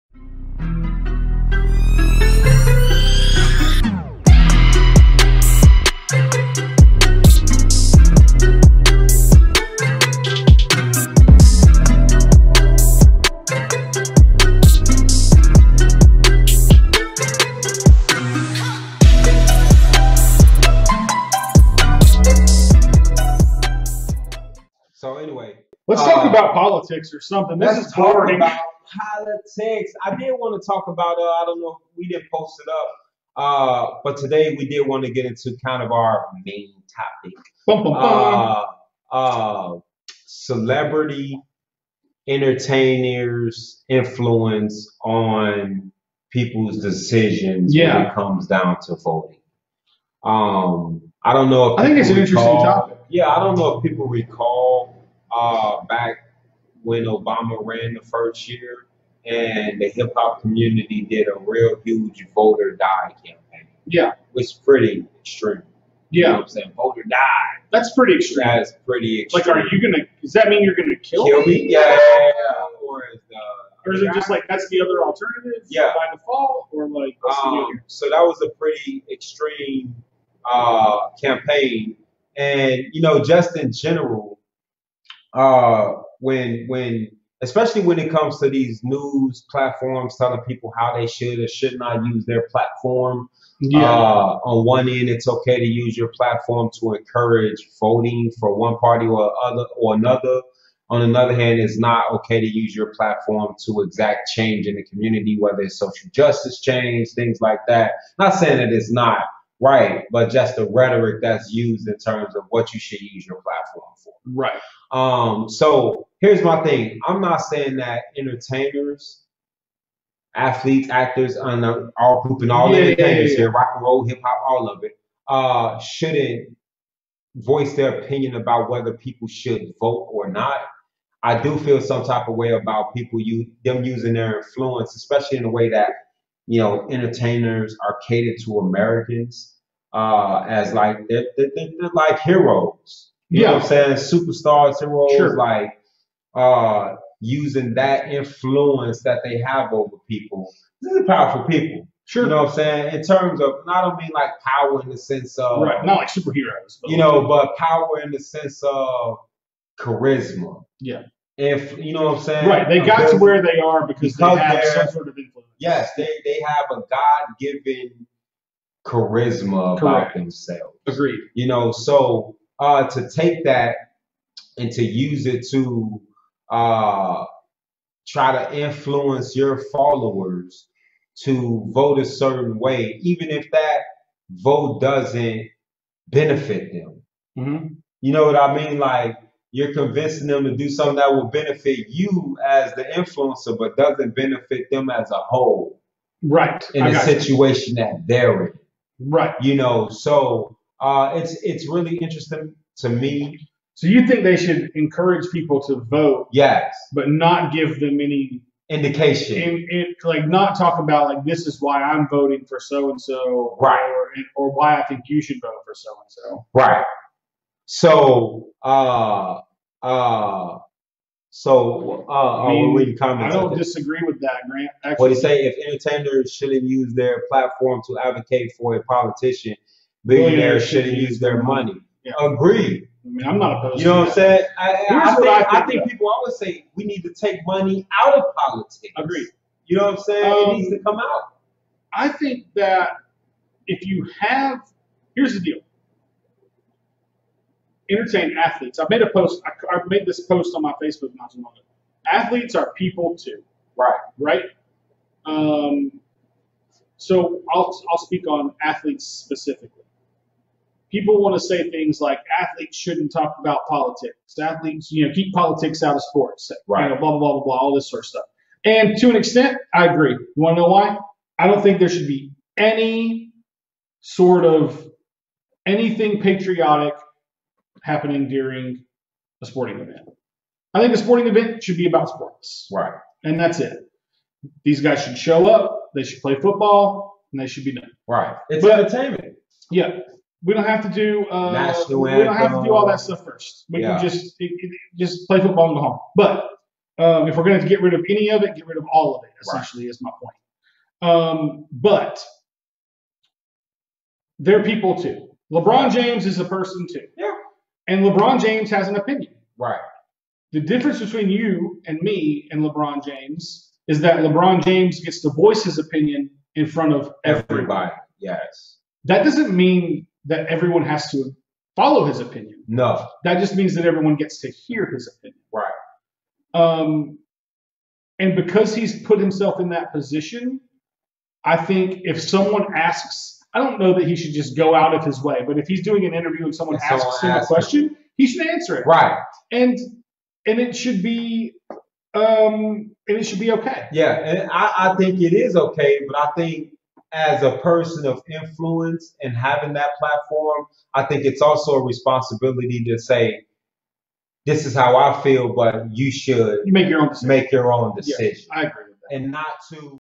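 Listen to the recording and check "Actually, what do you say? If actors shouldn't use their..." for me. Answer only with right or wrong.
wrong.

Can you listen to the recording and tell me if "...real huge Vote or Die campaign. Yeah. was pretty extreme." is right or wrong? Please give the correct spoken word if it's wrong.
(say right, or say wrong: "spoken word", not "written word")
right.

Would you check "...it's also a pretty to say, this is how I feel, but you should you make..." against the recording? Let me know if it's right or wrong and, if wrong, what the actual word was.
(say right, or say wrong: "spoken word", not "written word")
wrong: "responsibility", not "pretty".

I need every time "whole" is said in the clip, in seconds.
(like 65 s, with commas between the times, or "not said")
195 s.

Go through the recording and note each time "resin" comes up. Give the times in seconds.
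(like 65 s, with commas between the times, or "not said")
not said.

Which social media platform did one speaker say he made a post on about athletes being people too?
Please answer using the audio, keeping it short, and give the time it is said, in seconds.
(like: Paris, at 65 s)
Facebook, at 250 s.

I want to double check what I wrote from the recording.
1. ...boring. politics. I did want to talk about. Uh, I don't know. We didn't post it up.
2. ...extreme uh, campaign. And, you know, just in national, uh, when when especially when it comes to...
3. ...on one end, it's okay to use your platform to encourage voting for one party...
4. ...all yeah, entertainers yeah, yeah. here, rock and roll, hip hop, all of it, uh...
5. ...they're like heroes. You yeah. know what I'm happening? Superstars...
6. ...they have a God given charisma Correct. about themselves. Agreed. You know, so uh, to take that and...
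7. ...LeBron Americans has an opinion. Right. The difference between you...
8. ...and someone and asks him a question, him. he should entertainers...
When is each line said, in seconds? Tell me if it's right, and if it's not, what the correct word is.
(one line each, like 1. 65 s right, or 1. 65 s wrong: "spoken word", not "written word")
1. 27 s right
2. 79 s wrong: "general", not "national"
3. 94 s right
4. 122 s right
5. 141 s wrong: "saying", not "happening"
6. 166 s right
7. 308 s wrong: "James", not "Americans"
8. 336 s wrong: "answer", not "entertainers".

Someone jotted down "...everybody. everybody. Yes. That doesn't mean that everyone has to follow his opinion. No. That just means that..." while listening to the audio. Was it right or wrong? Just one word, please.
right.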